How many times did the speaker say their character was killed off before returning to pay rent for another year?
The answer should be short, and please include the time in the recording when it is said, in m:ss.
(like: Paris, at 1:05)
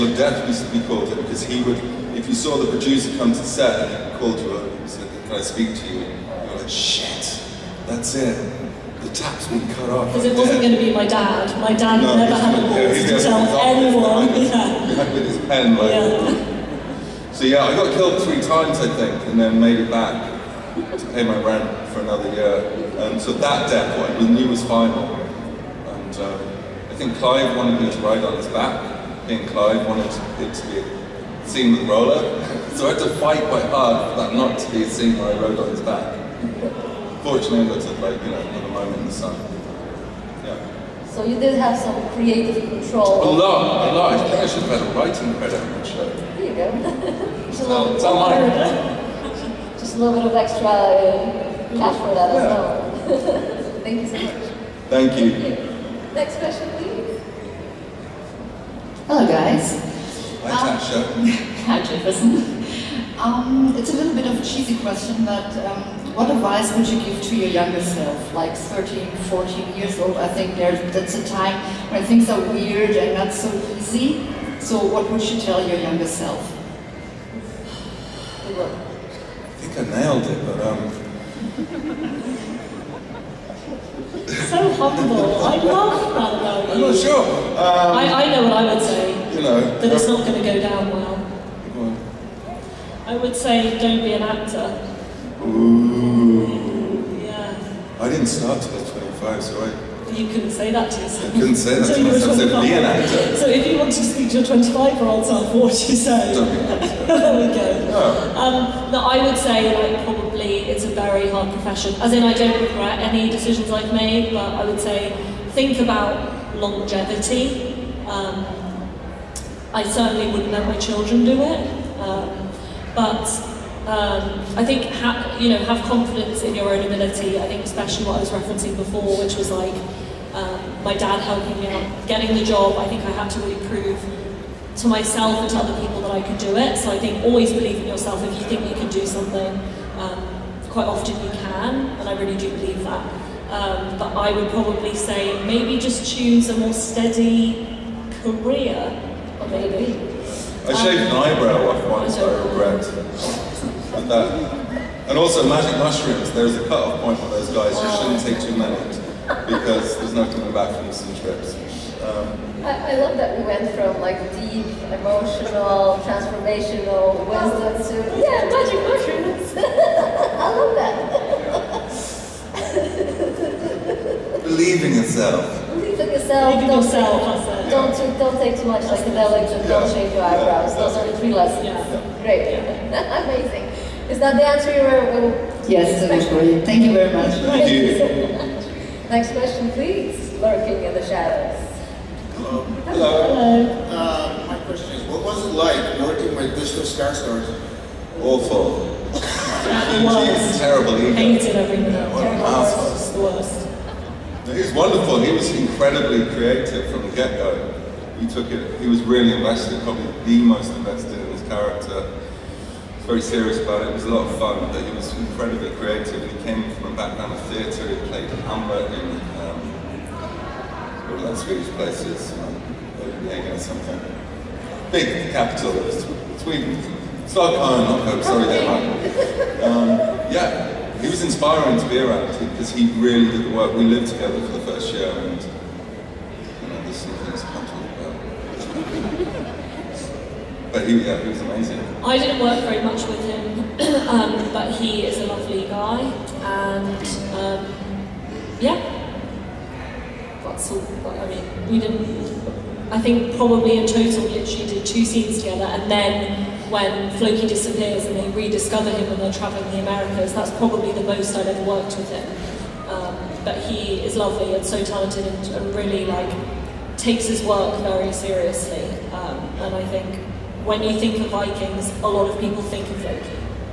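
3, at 0:18.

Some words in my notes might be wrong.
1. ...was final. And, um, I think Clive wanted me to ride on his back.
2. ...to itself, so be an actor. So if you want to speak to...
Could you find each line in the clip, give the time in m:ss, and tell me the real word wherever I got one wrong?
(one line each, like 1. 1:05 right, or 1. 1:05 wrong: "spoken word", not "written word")
1. 0:24 right
2. 1:41 wrong: "myself", not "itself".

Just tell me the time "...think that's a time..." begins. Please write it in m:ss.
1:10.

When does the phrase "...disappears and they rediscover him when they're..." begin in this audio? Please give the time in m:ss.
4:17.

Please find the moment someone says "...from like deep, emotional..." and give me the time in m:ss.
2:43.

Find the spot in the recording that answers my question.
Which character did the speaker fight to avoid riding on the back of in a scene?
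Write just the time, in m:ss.
0:31.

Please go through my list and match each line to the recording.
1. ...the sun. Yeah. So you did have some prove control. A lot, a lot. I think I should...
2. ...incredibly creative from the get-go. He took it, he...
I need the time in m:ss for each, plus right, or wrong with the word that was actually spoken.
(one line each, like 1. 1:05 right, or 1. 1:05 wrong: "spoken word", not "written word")
1. 0:39 wrong: "creative", not "prove"
2. 3:25 right.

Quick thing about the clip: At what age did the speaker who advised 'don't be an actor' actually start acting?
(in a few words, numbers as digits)
25.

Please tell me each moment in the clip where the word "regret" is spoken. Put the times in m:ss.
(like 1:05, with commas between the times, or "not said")
1:52, 2:32.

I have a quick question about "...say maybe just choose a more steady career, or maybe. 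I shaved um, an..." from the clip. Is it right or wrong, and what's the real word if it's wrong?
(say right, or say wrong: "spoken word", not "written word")
right.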